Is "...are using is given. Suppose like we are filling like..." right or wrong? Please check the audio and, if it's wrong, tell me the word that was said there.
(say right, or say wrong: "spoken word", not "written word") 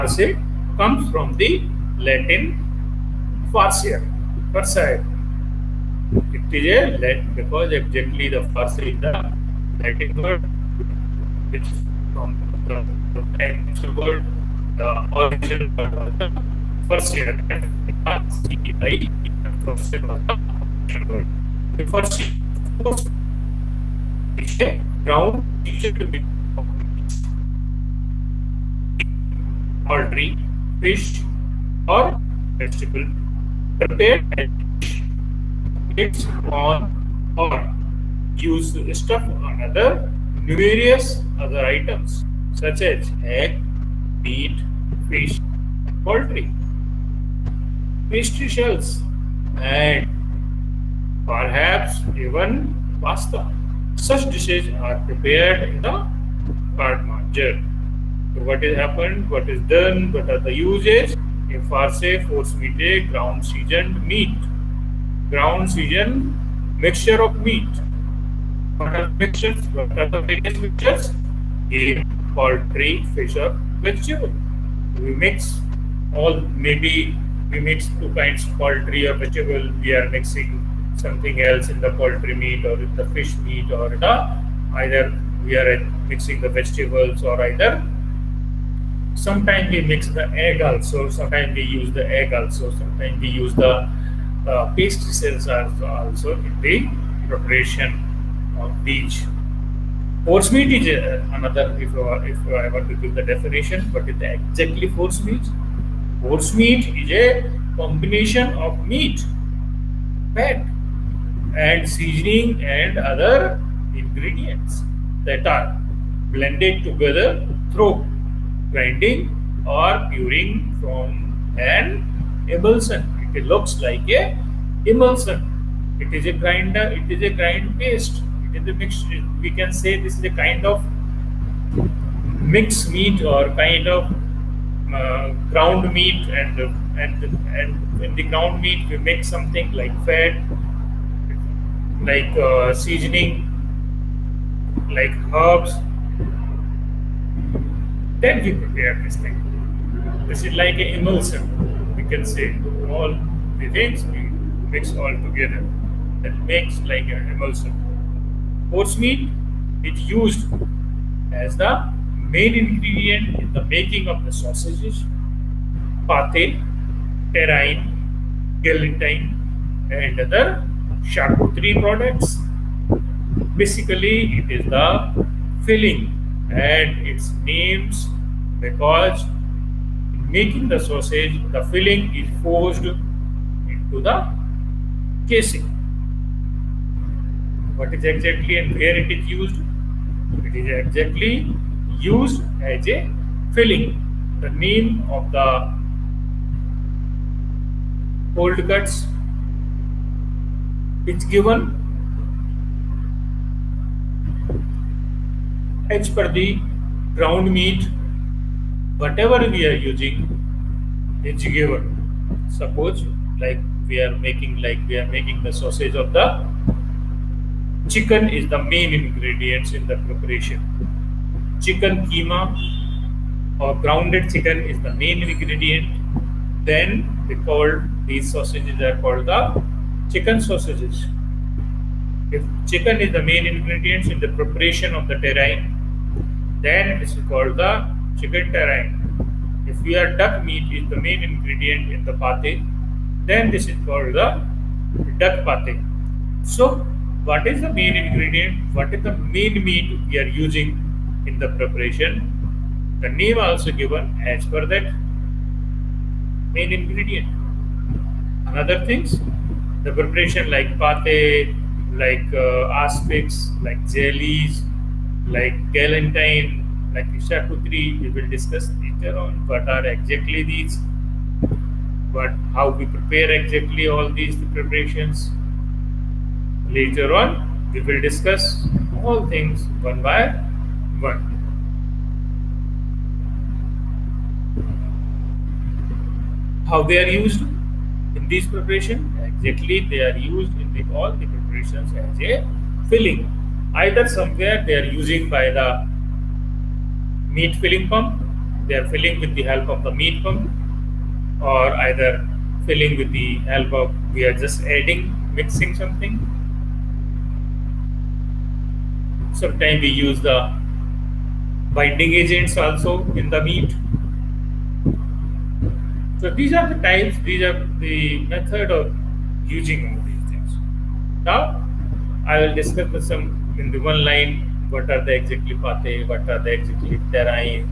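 wrong: "making", not "filling".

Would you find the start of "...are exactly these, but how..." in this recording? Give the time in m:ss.
4:29.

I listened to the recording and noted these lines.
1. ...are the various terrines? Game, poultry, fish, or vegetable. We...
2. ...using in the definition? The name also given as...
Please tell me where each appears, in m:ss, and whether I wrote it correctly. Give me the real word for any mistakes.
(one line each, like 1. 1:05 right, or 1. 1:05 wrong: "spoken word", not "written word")
1. 1:09 wrong: "mixtures", not "terrines"
2. 4:10 wrong: "preparation", not "definition".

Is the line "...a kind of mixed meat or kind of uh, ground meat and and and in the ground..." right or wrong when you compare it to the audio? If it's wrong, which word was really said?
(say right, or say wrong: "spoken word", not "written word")
right.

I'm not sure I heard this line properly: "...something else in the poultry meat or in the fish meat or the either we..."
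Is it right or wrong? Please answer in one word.
right.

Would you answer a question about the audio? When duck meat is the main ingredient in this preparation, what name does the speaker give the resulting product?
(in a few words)
duck pate.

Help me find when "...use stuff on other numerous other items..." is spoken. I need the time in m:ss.
0:38.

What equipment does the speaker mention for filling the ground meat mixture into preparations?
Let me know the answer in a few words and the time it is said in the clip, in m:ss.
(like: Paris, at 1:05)
meat pump, at 4:59.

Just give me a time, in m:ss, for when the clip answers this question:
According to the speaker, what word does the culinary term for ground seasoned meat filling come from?
0:03.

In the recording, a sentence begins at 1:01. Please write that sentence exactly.
A farce, force meat, ground seasoned meat.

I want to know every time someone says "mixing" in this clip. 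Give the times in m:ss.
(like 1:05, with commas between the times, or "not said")
1:20, 1:26, 5:05.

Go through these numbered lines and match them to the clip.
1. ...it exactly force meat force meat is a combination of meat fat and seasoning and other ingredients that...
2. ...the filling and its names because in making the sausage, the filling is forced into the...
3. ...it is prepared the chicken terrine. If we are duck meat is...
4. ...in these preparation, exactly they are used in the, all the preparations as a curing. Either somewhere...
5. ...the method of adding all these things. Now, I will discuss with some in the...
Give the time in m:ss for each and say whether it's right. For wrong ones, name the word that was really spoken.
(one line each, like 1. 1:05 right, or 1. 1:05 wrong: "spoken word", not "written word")
1. 1:44 right
2. 2:54 right
3. 3:56 wrong: "called", not "prepared"
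4. 4:48 wrong: "filling", not "curing"
5. 5:17 wrong: "using", not "adding".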